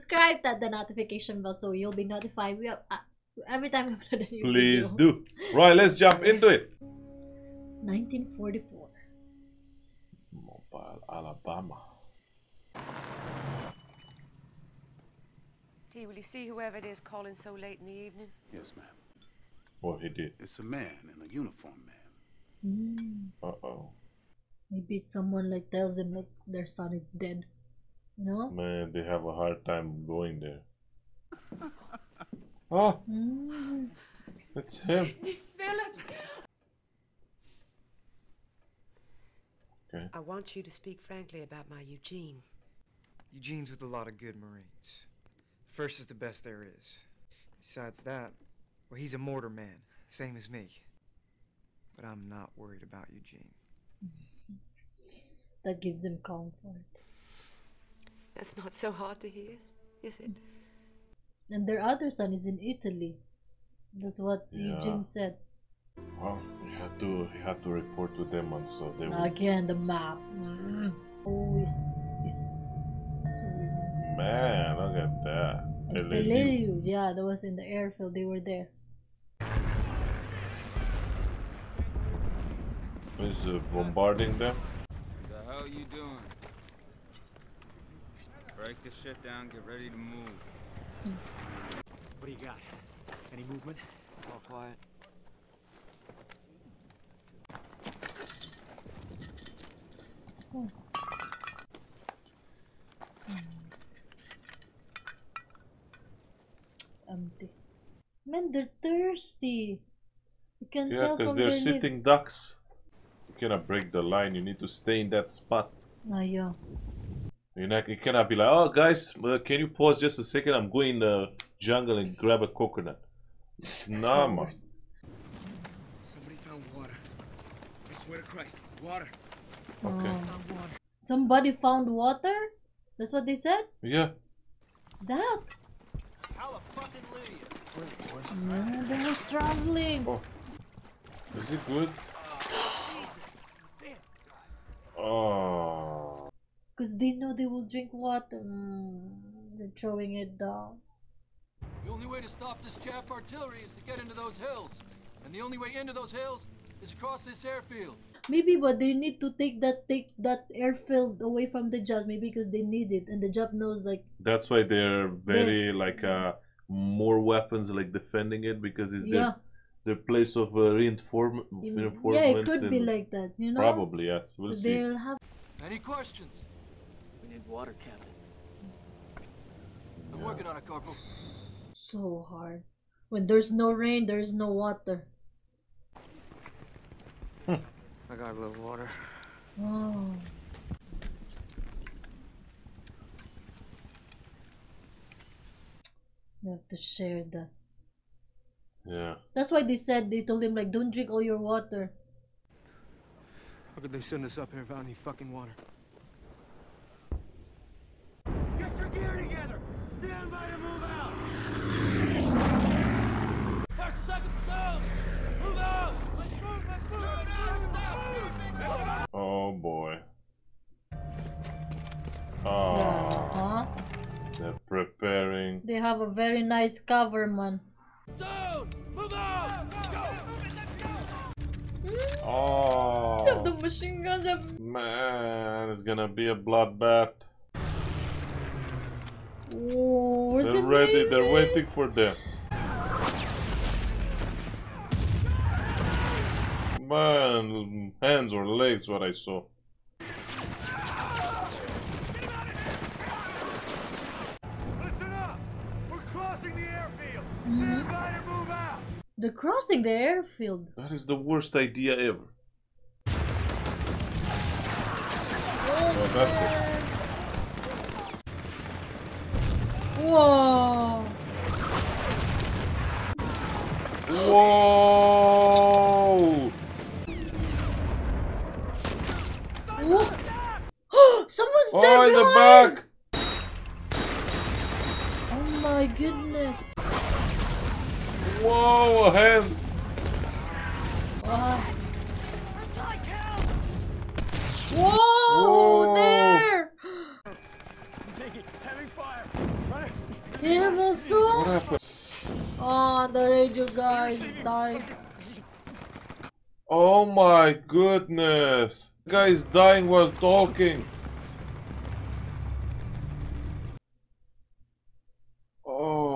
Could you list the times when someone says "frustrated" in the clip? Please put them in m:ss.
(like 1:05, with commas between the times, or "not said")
not said.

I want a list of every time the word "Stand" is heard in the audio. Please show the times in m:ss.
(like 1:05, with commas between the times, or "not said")
3:30.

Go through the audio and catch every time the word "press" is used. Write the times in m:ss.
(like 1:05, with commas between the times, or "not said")
not said.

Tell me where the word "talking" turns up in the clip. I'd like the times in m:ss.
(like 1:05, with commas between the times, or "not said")
5:10.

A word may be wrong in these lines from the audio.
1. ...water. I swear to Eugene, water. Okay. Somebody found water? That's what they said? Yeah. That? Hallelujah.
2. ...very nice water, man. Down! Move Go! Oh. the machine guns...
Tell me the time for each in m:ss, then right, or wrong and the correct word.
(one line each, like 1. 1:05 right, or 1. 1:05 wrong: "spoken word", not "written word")
1. 2:06 wrong: "Christ", not "Eugene"
2. 3:46 wrong: "cover", not "water".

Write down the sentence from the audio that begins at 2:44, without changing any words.
That's why they're very they're, like uh, more weapons like defending it because it's yeah.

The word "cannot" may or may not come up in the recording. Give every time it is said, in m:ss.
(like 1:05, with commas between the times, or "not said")
1:53, 1:58.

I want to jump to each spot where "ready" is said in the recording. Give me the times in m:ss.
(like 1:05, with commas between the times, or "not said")
1:29, 4:00.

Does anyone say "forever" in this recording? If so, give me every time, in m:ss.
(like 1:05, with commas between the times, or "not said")
not said.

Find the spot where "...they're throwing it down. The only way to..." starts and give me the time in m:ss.
2:29.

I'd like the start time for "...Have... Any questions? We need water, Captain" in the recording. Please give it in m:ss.
2:54.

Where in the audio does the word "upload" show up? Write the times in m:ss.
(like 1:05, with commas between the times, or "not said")
0:04.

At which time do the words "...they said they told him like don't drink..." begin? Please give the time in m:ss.
3:19.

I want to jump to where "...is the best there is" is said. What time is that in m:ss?
0:45.